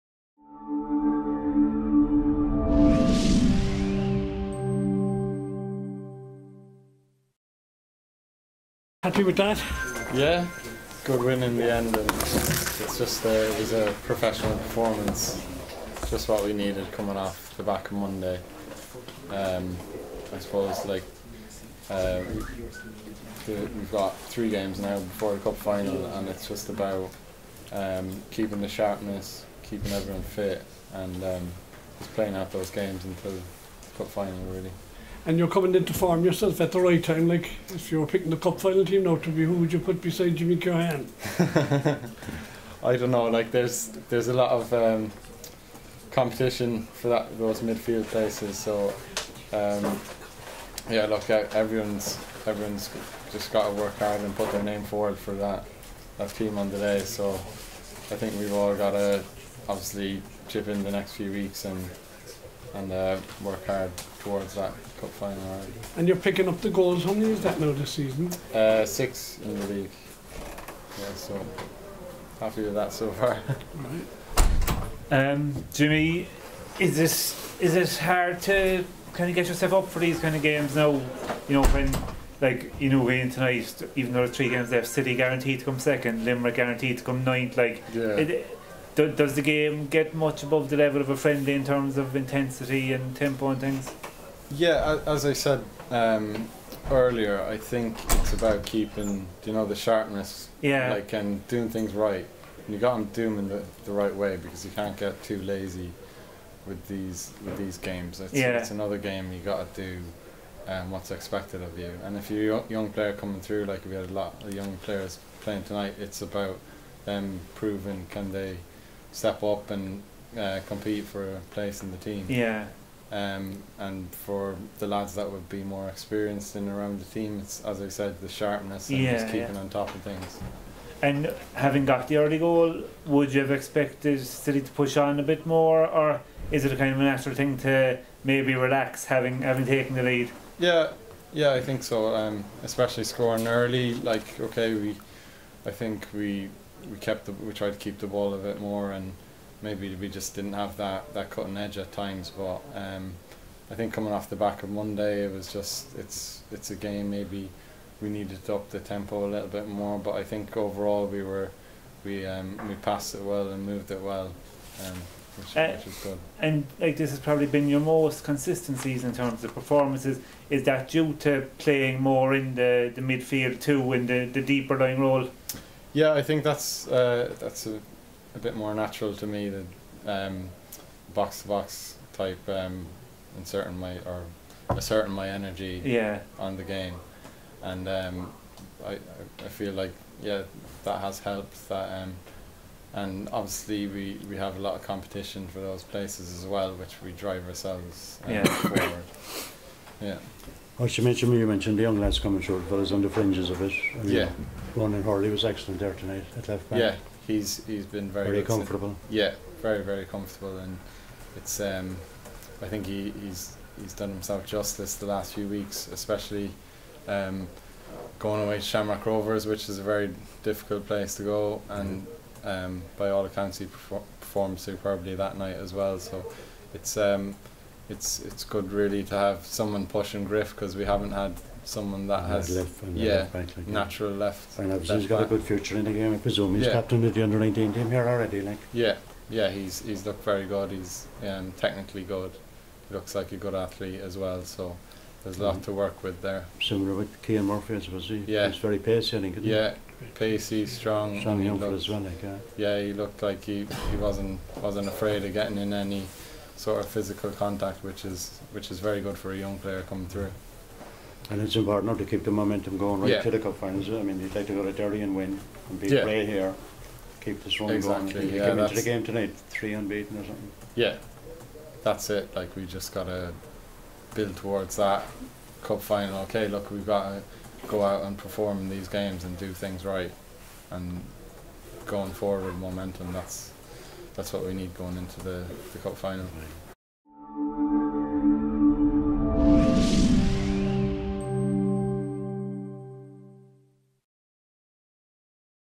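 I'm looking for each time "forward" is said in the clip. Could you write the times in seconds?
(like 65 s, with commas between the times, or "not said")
54 s, 198 s, 282 s.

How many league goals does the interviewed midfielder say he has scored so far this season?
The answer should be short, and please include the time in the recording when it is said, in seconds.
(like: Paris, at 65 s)
6, at 68 s.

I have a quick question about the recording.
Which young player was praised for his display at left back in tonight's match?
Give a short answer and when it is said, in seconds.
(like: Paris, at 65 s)
Ronan Hurley, at 204 s.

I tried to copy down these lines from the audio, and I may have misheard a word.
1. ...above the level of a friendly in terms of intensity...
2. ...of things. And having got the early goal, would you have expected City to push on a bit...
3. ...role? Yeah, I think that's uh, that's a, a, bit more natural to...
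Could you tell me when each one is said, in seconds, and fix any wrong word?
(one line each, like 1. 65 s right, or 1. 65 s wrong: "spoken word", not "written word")
1. 90 s right
2. 129 s right
3. 174 s right.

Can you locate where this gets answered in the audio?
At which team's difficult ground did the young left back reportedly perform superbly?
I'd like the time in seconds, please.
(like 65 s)
218 s.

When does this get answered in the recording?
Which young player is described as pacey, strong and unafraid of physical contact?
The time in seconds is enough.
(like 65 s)
247 s.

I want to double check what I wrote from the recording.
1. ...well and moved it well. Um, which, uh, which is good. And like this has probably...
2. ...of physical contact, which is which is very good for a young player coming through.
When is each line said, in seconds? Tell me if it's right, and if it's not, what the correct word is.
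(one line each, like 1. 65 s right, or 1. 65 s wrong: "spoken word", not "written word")
1. 163 s right
2. 256 s right.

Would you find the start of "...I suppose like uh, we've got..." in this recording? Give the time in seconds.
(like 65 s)
20 s.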